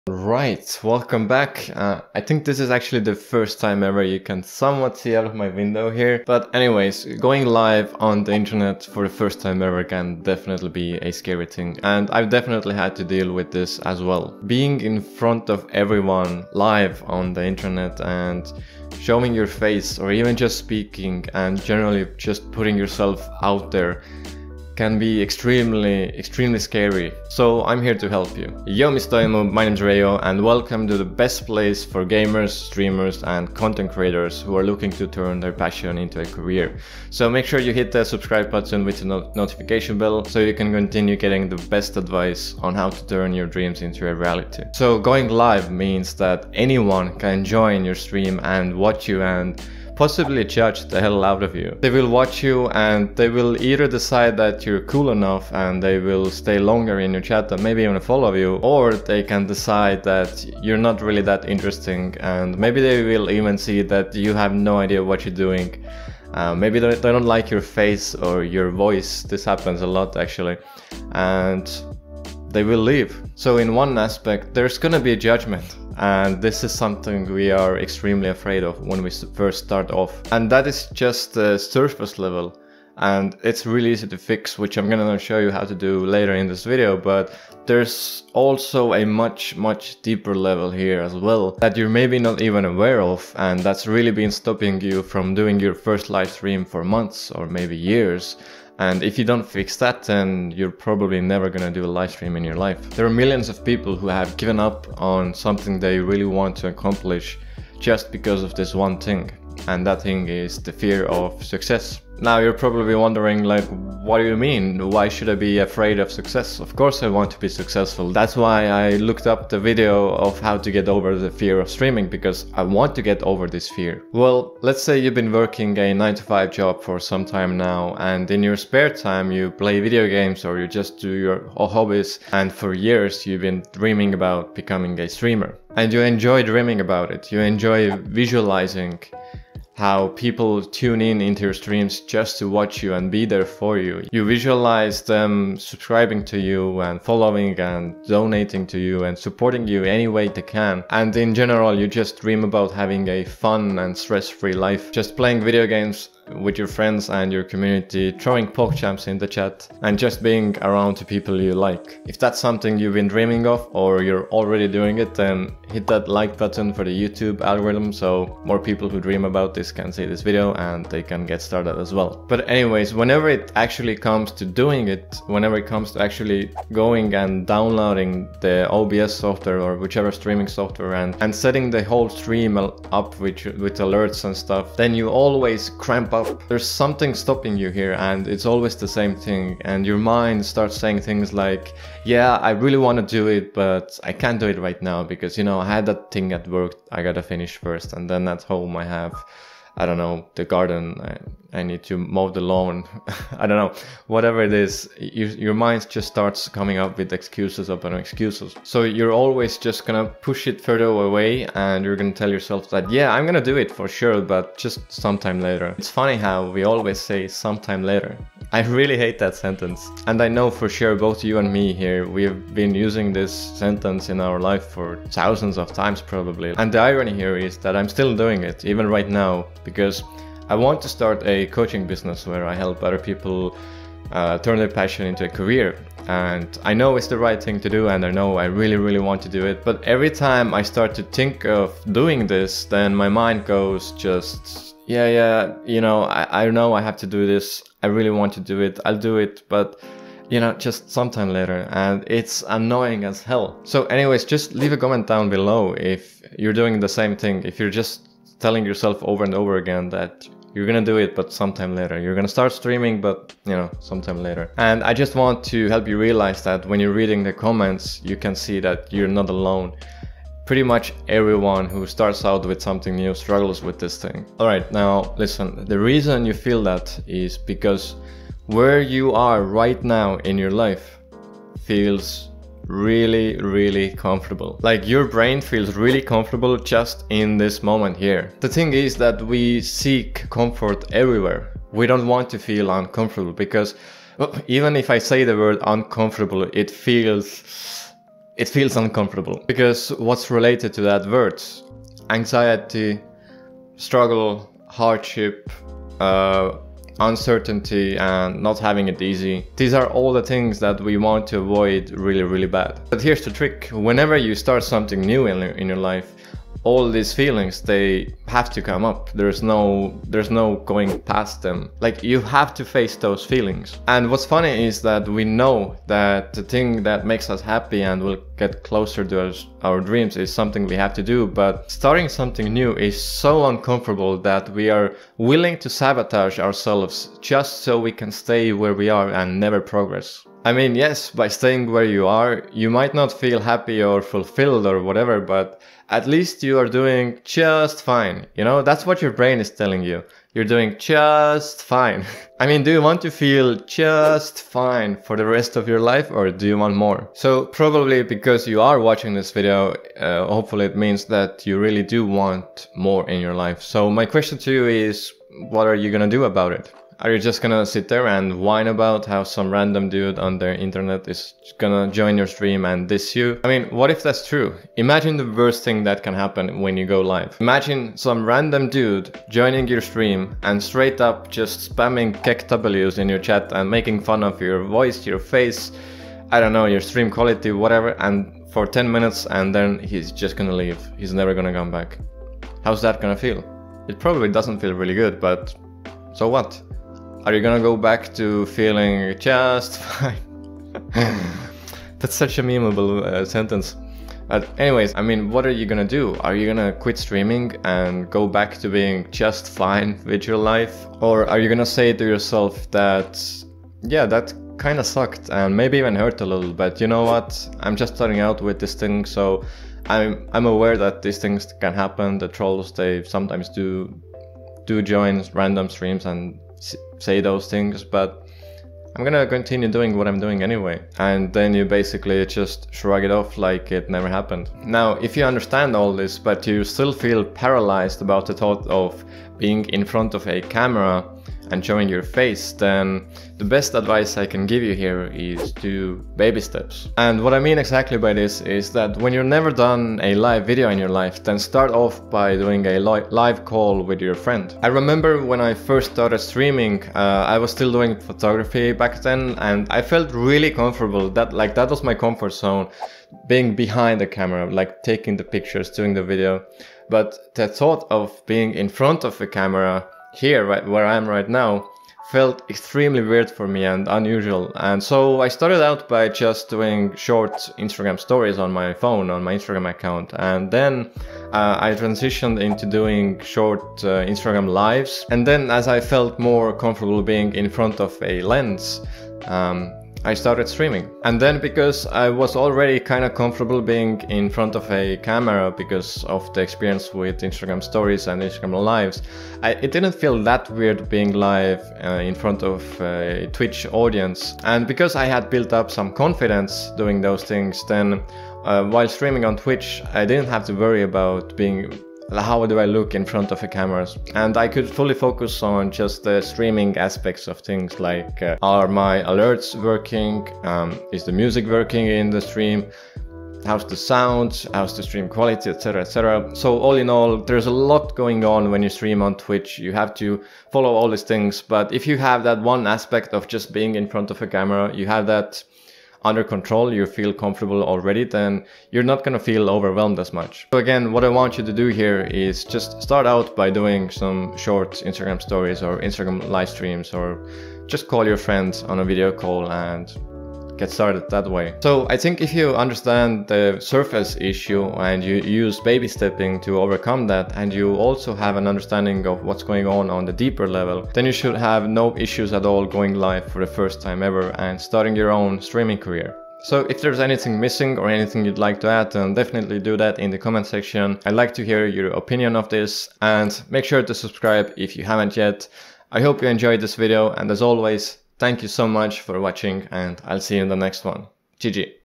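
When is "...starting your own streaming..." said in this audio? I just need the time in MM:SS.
09:24.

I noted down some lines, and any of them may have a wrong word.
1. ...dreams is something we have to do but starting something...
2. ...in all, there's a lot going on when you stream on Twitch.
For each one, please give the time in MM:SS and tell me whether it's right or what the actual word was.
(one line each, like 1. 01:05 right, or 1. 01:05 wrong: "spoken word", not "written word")
1. 05:29 right
2. 08:46 right.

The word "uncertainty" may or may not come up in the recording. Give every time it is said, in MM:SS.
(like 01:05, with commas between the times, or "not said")
05:06.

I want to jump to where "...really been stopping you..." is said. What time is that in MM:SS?
01:33.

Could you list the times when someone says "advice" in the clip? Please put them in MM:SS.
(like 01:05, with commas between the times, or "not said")
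00:41, 07:23.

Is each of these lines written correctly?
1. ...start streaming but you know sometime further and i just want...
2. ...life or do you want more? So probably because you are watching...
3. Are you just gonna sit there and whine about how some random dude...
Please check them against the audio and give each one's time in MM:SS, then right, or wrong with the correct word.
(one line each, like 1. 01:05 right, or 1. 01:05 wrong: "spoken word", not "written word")
1. 04:22 wrong: "later", not "further"
2. 05:55 right
3. 06:07 right.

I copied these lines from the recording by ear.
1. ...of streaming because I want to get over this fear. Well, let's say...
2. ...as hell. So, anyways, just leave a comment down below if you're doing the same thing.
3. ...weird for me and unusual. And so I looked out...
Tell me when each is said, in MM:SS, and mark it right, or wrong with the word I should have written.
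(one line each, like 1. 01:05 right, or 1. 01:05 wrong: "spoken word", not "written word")
1. 02:01 right
2. 04:13 right
3. 07:53 wrong: "started", not "looked".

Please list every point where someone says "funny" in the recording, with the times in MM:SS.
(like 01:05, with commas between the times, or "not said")
03:35, 05:24.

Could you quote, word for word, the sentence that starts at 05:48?
You know, that's what your brain is telling you.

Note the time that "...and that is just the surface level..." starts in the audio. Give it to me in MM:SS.
01:20.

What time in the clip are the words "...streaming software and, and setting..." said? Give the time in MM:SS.
03:00.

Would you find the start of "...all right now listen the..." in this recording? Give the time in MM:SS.
04:34.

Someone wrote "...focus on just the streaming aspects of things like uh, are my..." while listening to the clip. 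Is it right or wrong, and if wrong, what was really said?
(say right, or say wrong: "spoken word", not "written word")
right.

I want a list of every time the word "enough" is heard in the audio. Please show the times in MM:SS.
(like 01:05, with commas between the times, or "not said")
00:55.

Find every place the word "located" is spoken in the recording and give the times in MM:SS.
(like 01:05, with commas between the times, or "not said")
not said.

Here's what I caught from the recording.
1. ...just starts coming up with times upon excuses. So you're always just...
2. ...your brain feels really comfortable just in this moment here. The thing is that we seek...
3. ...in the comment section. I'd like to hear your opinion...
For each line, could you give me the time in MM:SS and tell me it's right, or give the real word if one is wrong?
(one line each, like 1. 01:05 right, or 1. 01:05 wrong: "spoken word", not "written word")
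1. 03:25 wrong: "excuses", not "times"
2. 04:44 right
3. 09:29 right.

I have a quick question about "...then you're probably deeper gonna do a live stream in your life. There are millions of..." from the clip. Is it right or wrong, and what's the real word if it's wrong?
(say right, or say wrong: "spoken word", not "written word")
wrong: "never", not "deeper".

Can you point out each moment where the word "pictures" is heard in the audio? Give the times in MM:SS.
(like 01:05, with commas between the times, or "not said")
07:45.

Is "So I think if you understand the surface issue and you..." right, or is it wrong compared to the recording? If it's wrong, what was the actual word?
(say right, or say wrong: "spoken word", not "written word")
right.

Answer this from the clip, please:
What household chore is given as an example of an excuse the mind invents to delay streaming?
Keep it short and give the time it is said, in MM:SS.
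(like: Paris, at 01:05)
mow the lawn, at 03:21.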